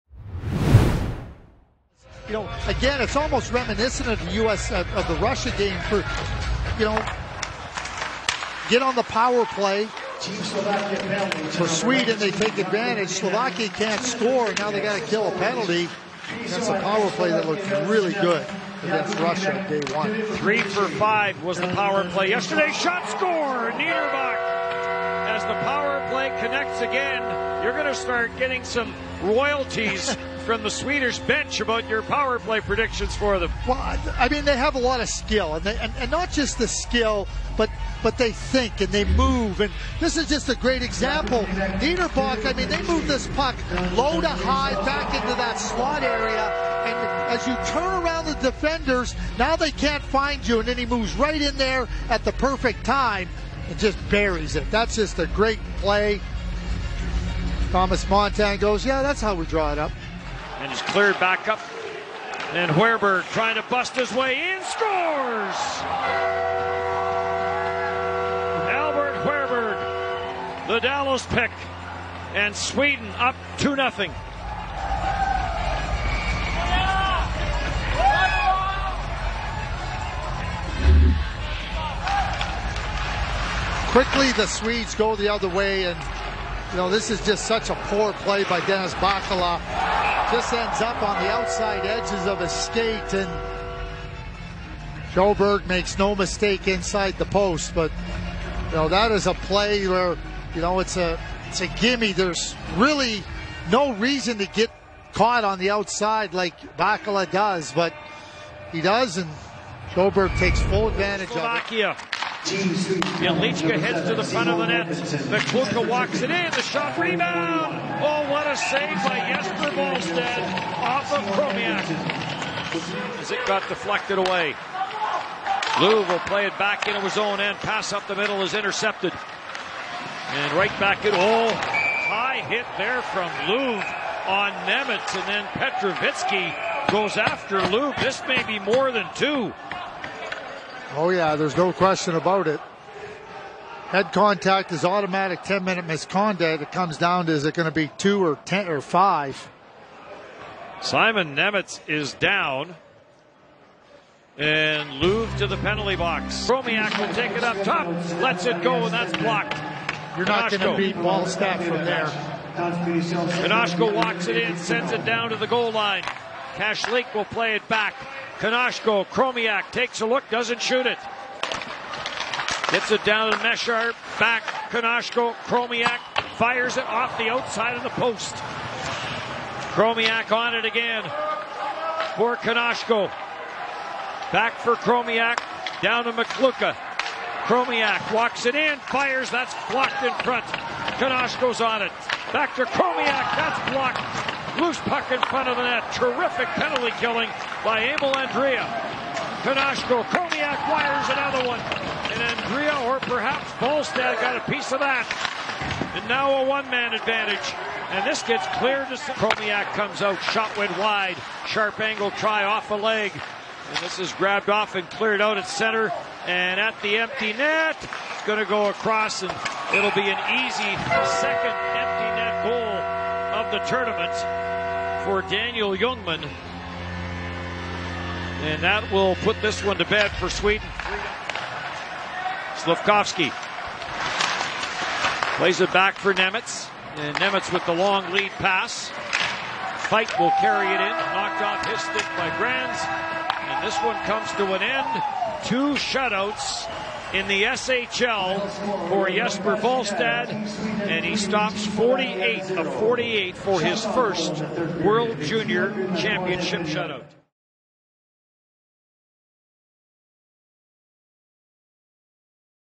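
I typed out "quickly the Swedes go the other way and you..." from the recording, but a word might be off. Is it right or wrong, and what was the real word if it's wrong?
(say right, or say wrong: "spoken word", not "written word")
right.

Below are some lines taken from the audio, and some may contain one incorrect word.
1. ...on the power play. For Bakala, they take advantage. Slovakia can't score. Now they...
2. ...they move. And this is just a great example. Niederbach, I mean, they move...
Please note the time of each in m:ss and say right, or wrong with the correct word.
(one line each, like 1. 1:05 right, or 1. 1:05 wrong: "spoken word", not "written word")
1. 0:08 wrong: "Sweden", not "Bakala"
2. 0:38 right.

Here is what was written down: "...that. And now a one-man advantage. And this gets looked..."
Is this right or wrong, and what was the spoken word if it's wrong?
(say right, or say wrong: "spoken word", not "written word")
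wrong: "cleared", not "looked".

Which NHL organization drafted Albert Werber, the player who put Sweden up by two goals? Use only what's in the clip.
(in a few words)
Dallas.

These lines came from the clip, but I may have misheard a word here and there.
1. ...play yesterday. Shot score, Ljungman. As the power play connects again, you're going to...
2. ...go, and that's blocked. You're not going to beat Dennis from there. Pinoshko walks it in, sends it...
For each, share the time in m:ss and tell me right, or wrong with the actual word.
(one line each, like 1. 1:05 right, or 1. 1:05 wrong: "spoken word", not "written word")
1. 0:22 wrong: "Niederbach", not "Ljungman"
2. 2:38 wrong: "Wallstedt", not "Dennis".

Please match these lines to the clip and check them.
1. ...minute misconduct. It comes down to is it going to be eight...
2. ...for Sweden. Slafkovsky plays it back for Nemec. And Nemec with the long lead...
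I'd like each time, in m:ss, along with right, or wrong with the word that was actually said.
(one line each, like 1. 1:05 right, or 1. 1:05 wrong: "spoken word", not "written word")
1. 2:25 wrong: "two", not "eight"
2. 3:50 right.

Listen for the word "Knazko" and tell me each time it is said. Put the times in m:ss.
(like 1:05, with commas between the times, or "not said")
2:48, 2:54, 3:02, 3:10, 3:19.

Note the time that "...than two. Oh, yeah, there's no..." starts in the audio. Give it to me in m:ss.
2:18.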